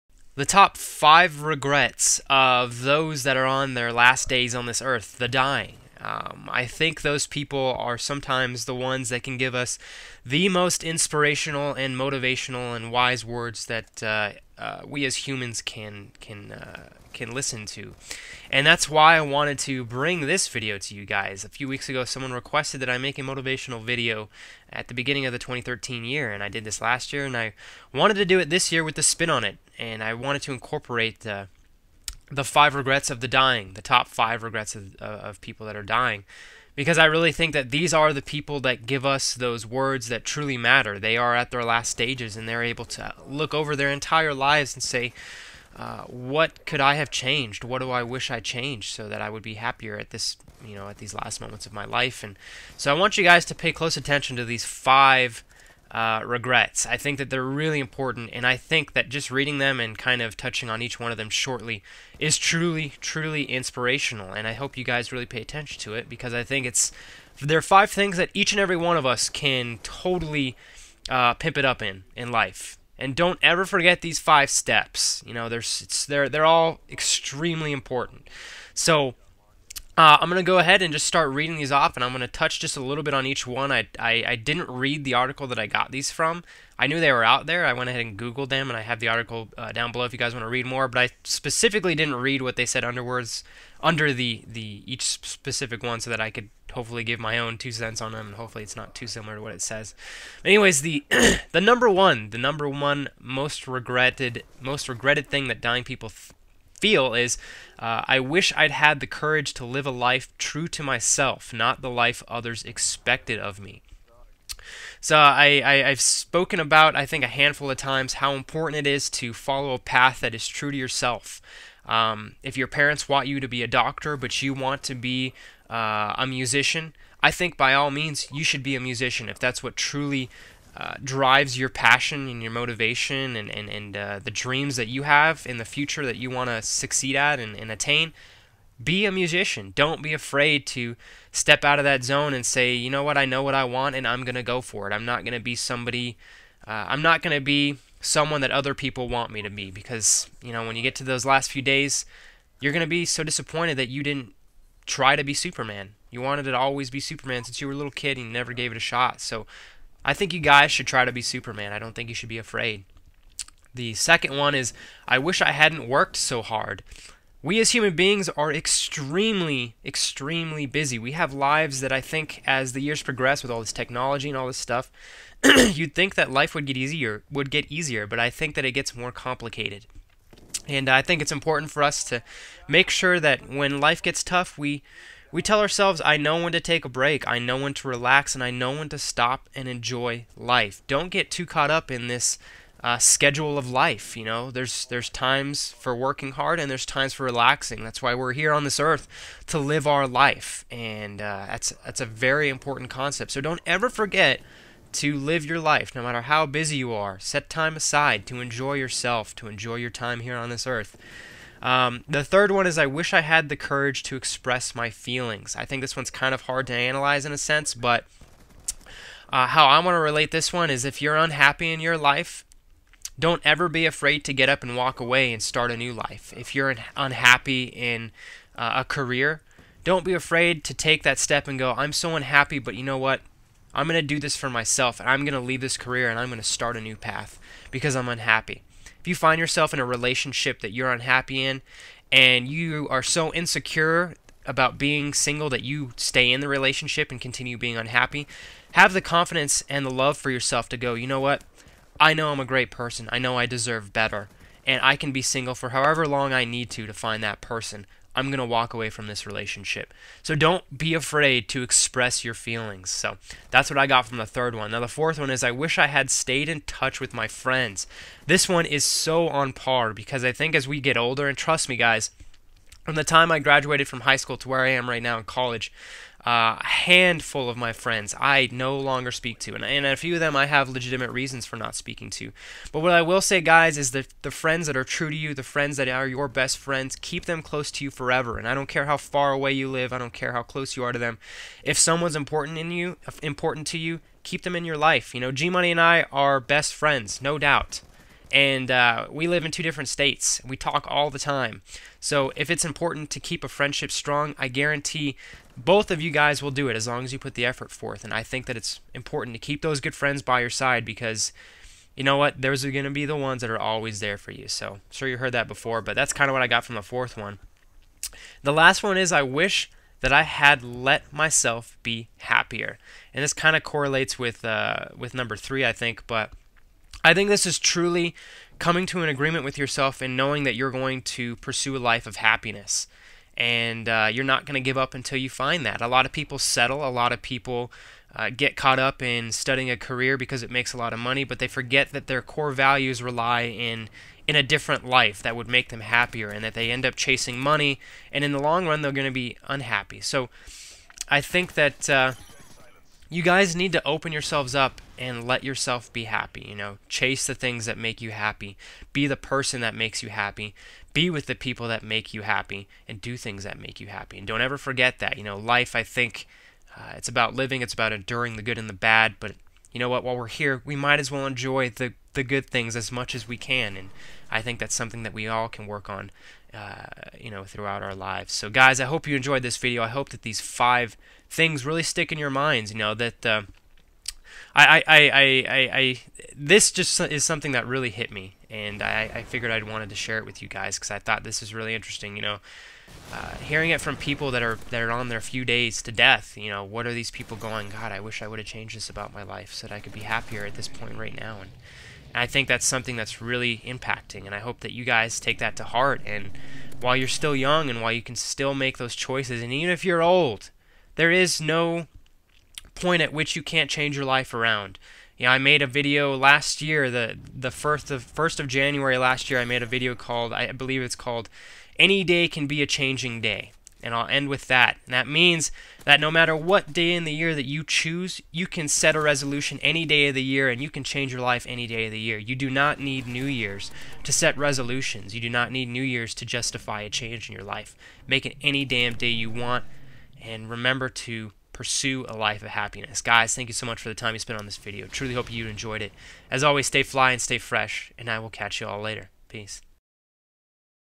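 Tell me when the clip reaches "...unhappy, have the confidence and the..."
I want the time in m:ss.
4:07.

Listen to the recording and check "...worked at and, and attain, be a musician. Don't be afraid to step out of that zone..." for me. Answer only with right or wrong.
wrong.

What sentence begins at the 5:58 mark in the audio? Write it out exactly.
Be the person that makes you happy.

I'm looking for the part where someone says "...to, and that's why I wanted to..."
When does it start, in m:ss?
0:17.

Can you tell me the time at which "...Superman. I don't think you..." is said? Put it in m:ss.
2:41.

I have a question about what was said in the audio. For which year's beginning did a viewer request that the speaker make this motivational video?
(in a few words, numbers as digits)
2013.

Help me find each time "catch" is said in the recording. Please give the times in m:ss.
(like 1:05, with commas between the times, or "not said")
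7:28.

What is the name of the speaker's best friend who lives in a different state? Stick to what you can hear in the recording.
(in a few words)
G Money.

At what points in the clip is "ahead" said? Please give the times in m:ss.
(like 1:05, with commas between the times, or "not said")
1:20, 1:27.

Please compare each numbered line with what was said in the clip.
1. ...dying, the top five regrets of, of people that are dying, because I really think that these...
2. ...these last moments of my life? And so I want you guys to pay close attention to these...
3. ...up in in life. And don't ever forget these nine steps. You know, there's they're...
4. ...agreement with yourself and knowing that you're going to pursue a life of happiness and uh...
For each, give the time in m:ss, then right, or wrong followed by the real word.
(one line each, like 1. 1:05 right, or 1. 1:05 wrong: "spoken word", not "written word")
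1. 0:33 right
2. 0:50 right
3. 1:11 wrong: "five", not "nine"
4. 5:29 right.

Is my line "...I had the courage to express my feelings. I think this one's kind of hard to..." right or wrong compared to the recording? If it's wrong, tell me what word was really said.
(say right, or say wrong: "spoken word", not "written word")
right.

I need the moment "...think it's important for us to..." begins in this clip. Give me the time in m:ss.
3:01.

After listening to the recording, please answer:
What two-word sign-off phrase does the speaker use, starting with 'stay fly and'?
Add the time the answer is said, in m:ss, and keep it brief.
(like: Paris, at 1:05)
stay fresh, at 7:27.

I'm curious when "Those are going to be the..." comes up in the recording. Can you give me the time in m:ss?
5:12.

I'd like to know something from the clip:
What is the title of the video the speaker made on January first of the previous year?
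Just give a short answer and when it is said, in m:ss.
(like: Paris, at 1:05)
Any Day Can Be a Changing Day, at 7:01.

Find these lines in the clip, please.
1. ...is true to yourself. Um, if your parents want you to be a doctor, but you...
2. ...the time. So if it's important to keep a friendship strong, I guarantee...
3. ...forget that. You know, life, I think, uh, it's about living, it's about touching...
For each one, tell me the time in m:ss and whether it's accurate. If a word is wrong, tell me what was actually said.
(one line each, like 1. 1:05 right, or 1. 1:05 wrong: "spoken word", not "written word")
1. 2:00 right
2. 5:01 right
3. 6:04 wrong: "enduring", not "touching".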